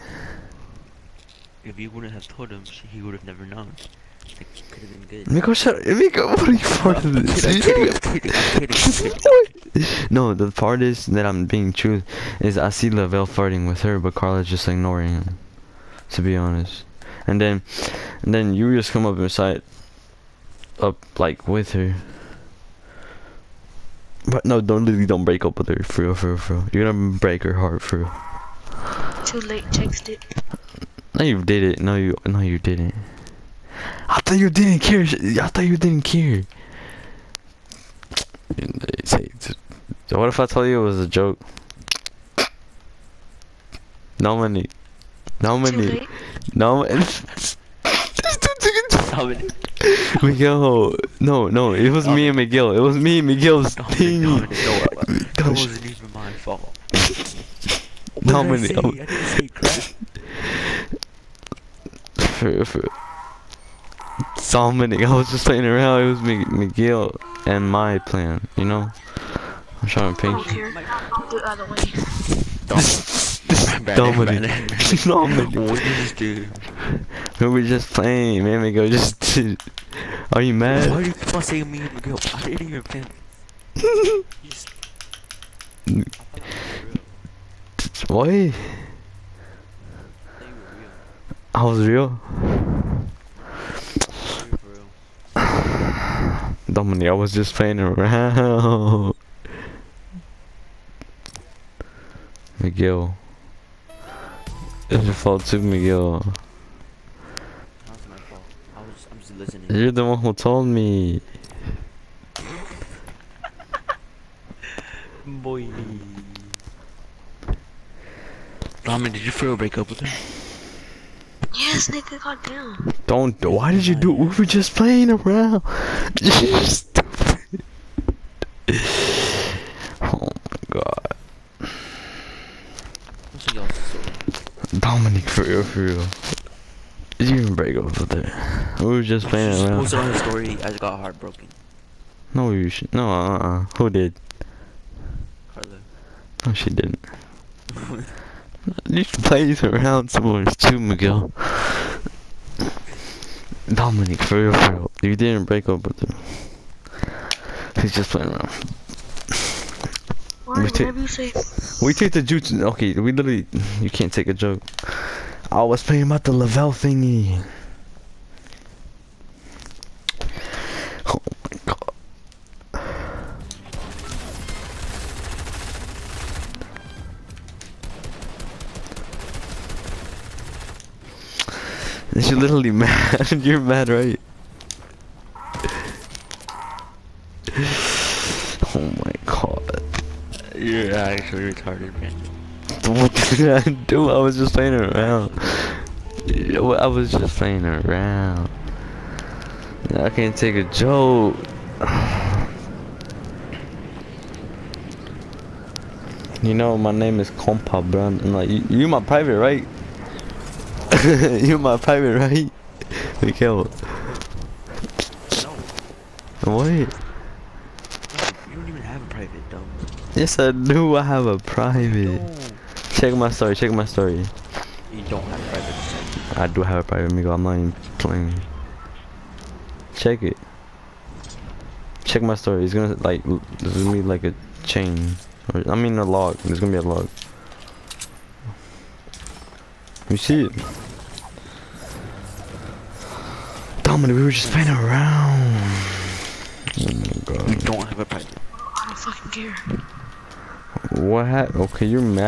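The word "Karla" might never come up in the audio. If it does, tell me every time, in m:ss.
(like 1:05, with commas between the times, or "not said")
0:14, 2:25.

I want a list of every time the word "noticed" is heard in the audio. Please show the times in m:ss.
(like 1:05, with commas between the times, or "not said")
not said.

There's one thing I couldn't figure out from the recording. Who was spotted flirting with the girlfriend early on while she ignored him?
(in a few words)
Lavelle.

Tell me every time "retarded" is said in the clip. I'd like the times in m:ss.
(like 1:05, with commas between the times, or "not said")
3:11.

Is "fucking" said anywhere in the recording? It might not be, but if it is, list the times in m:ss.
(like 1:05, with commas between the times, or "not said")
4:08.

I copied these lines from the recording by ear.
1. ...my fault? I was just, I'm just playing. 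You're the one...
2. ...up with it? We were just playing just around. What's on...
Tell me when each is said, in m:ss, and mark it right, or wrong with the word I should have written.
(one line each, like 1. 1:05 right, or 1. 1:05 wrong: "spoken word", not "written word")
1. 1:48 wrong: "listening", not "playing"
2. 2:17 right.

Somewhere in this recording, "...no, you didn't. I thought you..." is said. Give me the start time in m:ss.
0:32.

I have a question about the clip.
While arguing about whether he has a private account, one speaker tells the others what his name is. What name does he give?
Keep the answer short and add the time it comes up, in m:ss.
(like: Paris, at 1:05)
Compa, at 3:27.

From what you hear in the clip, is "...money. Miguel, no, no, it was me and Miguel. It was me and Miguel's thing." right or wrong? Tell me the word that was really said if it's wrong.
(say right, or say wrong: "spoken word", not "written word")
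right.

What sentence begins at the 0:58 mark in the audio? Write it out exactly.
Dominic, I, I didn't say crap for, for Dominic.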